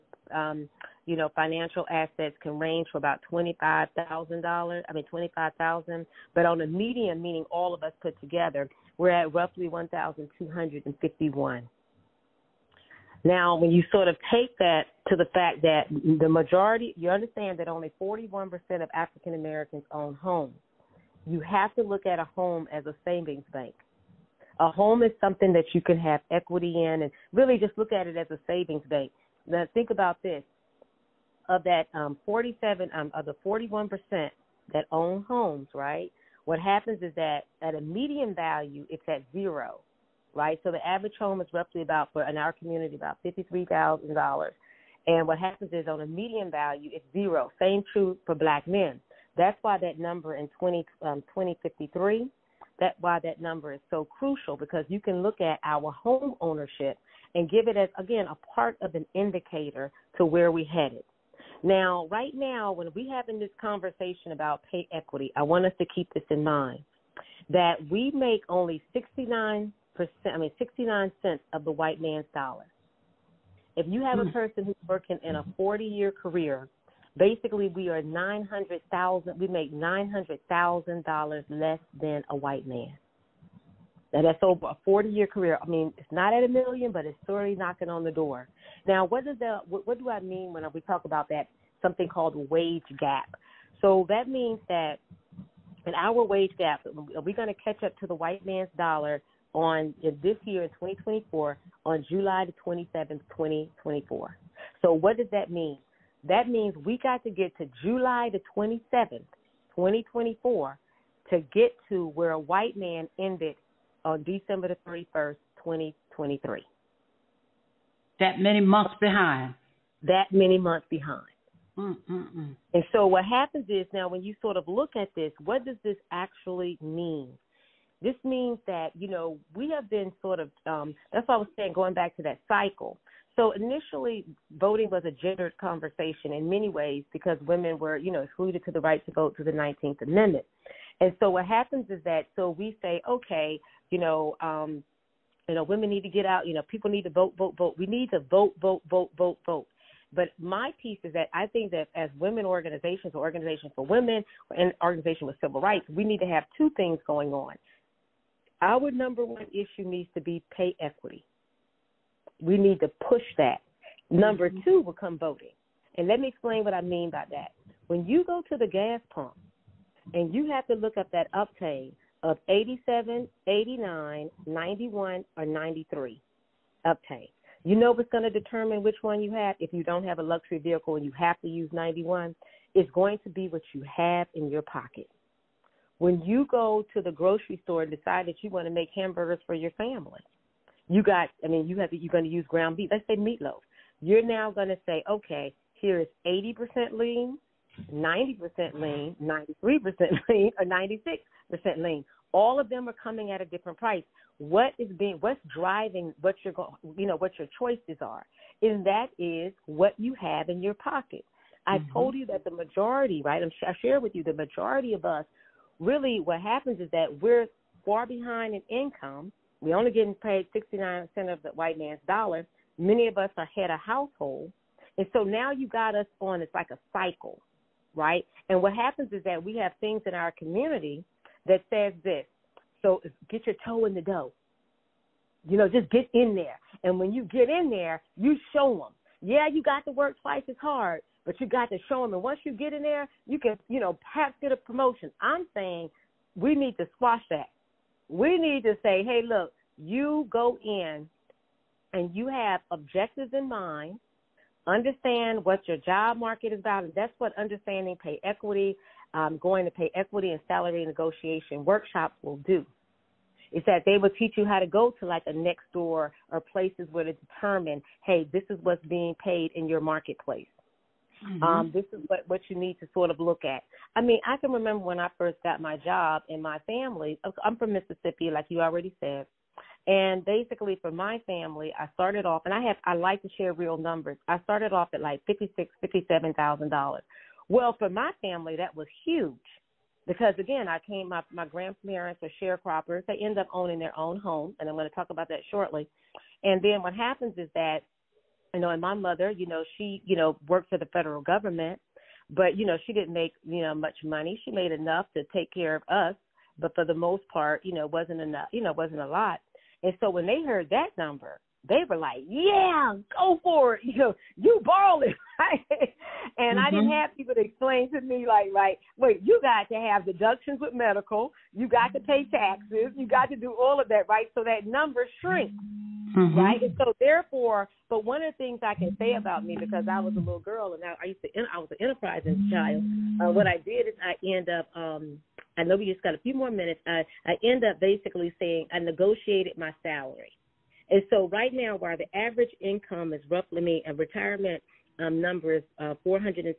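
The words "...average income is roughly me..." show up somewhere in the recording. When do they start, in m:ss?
5:42.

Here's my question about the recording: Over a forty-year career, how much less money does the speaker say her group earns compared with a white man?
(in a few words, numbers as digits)
$900,000.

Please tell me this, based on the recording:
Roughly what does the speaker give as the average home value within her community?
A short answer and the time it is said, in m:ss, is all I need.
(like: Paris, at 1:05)
$53,000, at 0:43.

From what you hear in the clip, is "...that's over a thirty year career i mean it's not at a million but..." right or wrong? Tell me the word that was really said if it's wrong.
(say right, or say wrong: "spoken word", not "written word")
wrong: "forty", not "thirty".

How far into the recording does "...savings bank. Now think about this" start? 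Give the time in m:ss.
0:28.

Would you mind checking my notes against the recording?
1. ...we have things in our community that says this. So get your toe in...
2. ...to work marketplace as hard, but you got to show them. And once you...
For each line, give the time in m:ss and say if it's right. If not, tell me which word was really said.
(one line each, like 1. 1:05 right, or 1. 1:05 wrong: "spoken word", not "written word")
1. 3:49 right
2. 3:59 wrong: "twice", not "marketplace".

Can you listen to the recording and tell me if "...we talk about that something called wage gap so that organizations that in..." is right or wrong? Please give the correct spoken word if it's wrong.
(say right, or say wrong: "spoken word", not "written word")
wrong: "means", not "organizations".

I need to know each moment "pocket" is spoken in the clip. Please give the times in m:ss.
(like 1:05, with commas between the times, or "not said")
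3:04, 3:30.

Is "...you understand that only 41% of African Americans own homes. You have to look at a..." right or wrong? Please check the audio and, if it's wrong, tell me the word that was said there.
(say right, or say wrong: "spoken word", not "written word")
right.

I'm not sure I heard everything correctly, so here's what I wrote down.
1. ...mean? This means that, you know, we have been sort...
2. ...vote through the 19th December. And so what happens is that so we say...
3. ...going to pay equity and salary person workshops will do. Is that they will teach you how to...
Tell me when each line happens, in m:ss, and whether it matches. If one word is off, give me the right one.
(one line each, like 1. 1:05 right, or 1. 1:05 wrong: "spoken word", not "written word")
1. 2:06 right
2. 2:19 wrong: "Amendment", not "December"
3. 4:19 wrong: "negotiation", not "person".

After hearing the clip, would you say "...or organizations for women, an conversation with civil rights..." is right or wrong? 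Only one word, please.
wrong.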